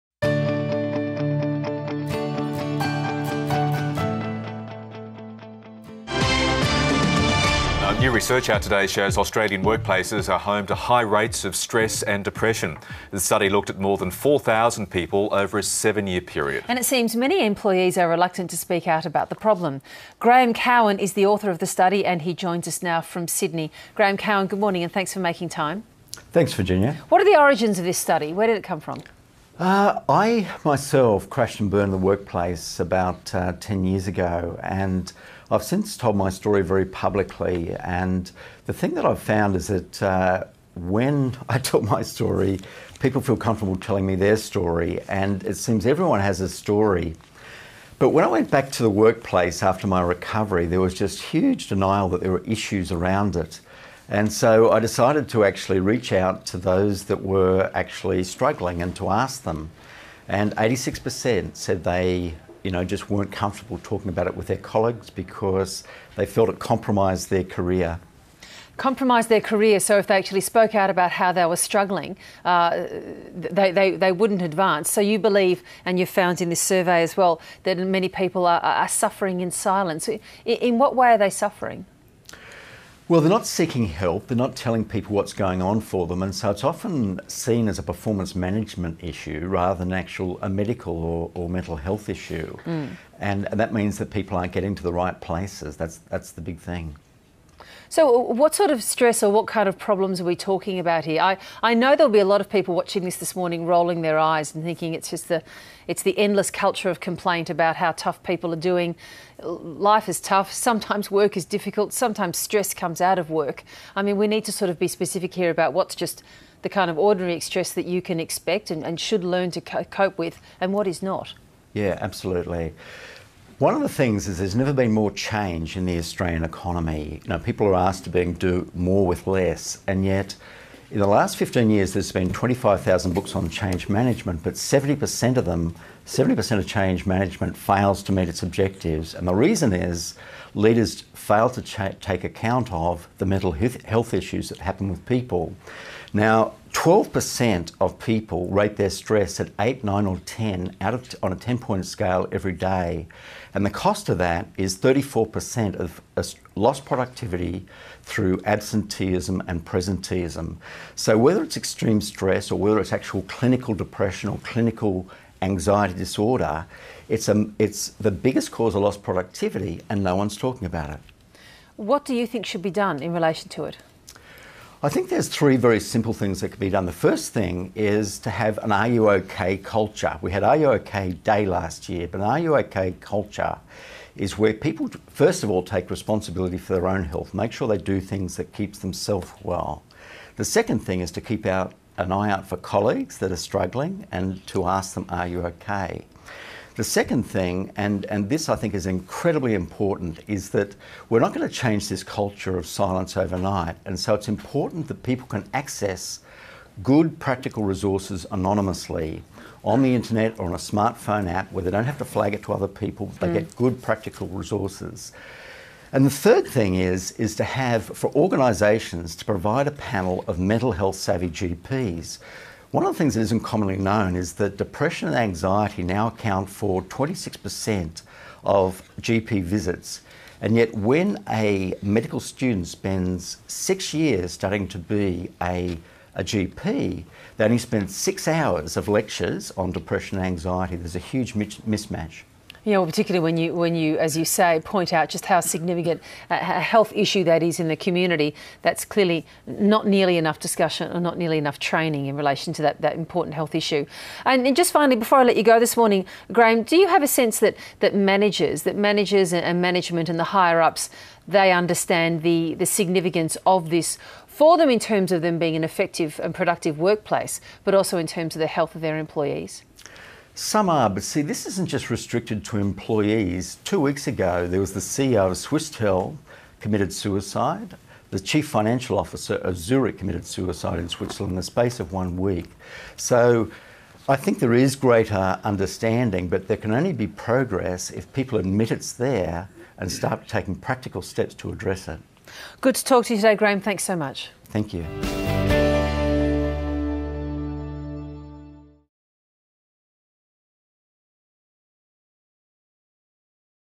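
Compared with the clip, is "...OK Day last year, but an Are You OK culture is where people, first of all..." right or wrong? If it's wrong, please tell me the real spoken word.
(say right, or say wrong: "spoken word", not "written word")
right.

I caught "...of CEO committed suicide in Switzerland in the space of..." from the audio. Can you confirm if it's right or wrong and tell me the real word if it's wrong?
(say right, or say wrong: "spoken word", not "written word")
wrong: "Zurich", not "CEO".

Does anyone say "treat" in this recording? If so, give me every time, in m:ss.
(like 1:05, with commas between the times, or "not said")
not said.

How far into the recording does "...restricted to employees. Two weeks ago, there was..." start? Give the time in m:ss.
4:31.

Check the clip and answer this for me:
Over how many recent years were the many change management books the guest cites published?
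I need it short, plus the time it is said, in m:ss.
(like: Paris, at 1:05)
15 years, at 2:11.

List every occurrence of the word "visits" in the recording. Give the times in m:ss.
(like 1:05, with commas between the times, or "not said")
3:49.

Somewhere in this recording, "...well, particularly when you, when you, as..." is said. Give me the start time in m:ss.
4:02.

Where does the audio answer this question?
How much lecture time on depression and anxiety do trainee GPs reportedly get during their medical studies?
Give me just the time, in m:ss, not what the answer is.
3:57.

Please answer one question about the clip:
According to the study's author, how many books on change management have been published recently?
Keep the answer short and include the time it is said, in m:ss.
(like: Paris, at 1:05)
25,000, at 2:12.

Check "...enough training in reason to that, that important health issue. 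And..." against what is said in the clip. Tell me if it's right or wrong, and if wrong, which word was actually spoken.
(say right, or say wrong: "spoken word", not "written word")
wrong: "relation", not "reason".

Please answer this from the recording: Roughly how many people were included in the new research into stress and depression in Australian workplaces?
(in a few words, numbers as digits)
More than 4,000.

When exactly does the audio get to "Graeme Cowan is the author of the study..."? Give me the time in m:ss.
0:20.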